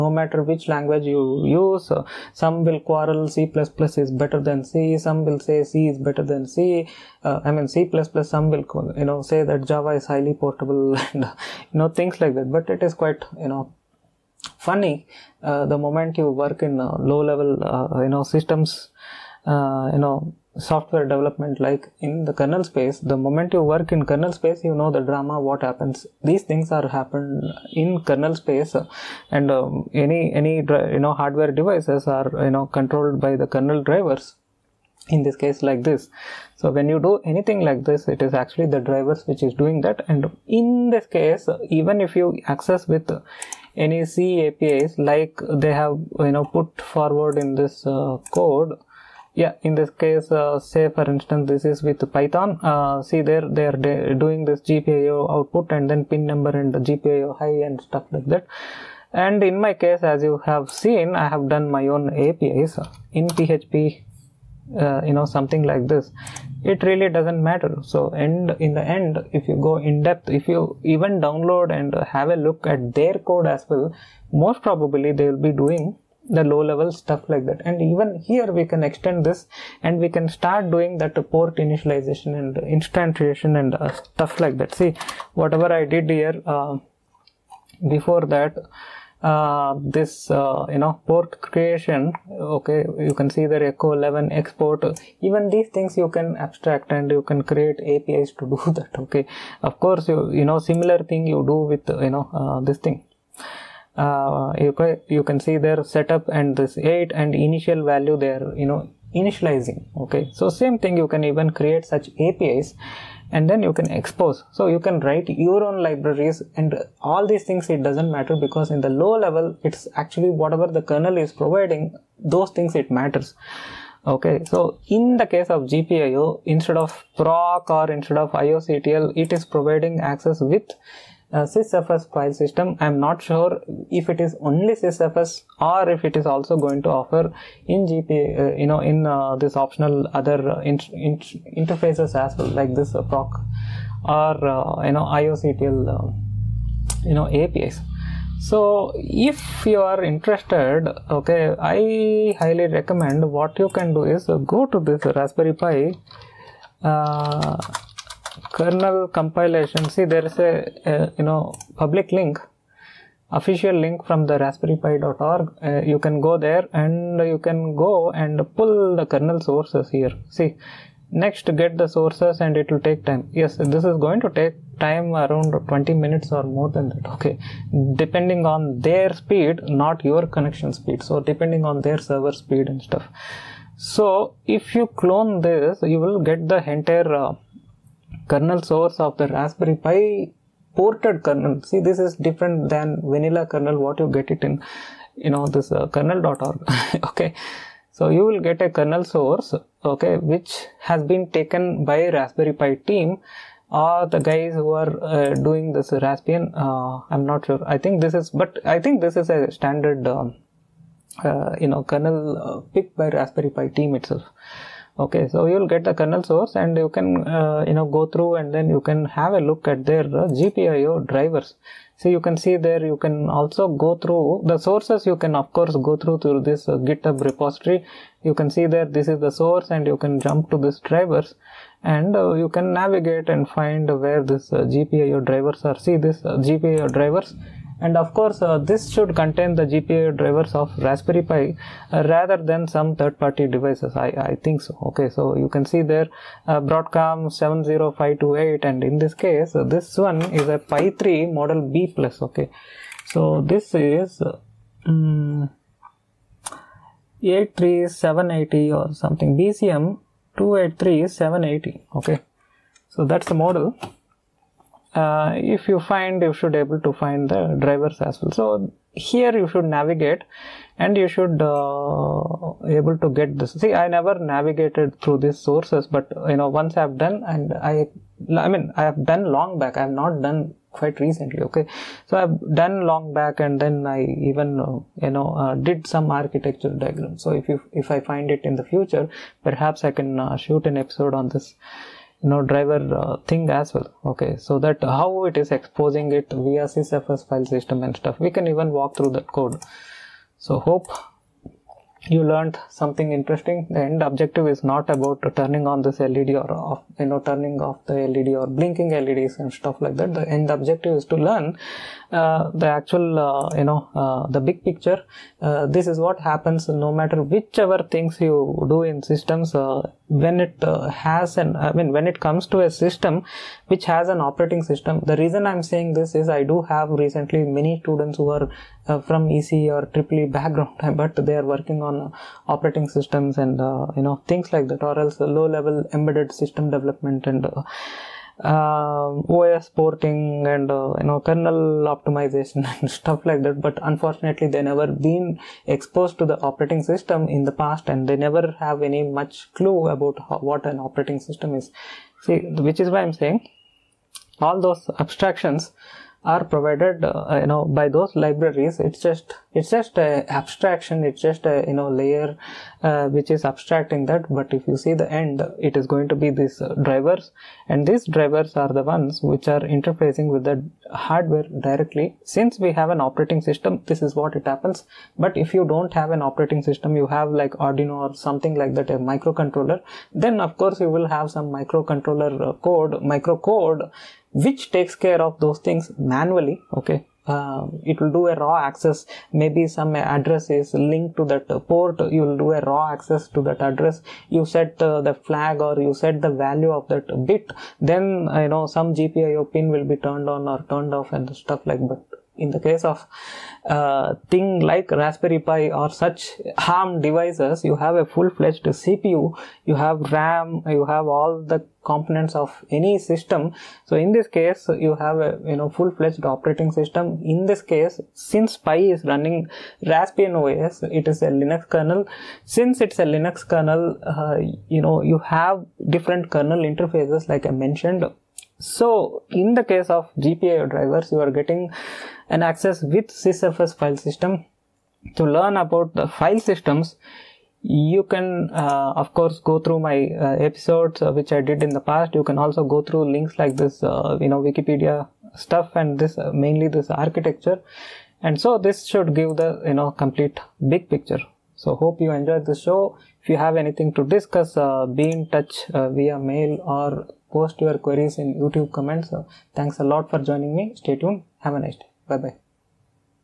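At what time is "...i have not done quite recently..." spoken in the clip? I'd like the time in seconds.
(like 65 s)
279 s.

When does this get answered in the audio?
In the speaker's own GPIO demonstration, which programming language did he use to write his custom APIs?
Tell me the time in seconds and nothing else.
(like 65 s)
63 s.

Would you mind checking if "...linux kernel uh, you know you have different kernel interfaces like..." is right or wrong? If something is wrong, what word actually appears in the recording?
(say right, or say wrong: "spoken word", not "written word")
right.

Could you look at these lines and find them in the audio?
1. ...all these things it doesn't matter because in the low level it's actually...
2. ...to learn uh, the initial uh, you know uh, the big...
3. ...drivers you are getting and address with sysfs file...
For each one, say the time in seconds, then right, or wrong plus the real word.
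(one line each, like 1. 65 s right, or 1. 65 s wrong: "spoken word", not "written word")
1. 116 s right
2. 311 s wrong: "actual", not "initial"
3. 430 s wrong: "access", not "address".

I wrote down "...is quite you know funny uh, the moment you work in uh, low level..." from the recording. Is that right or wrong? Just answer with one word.
right.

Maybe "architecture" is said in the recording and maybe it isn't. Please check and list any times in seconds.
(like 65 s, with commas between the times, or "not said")
286 s, 446 s.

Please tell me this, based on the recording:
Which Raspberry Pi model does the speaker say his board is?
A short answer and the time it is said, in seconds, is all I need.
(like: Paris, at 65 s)
Pi 3 Model B Plus, at 250 s.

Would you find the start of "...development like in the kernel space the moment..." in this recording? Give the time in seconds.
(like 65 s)
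21 s.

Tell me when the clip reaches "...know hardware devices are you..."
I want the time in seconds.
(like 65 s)
31 s.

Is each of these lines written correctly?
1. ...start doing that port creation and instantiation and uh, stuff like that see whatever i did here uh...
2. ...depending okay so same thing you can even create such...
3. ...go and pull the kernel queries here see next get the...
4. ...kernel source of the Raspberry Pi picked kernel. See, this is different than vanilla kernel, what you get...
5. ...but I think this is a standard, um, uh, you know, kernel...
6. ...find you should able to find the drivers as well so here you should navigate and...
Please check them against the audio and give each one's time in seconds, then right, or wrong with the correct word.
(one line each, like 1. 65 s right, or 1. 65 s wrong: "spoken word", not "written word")
1. 80 s wrong: "initialization", not "creation"
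2. 109 s wrong: "initializing", not "depending"
3. 167 s wrong: "sources", not "queries"
4. 188 s wrong: "ported", not "picked"
5. 208 s right
6. 265 s right.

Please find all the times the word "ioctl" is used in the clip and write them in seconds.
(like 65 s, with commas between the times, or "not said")
128 s, 145 s.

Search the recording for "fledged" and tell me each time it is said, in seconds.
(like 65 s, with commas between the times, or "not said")
408 s, 415 s.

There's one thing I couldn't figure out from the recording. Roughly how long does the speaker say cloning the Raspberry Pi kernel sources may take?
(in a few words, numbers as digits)
20 minutes.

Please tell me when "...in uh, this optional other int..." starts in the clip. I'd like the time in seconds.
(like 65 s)
138 s.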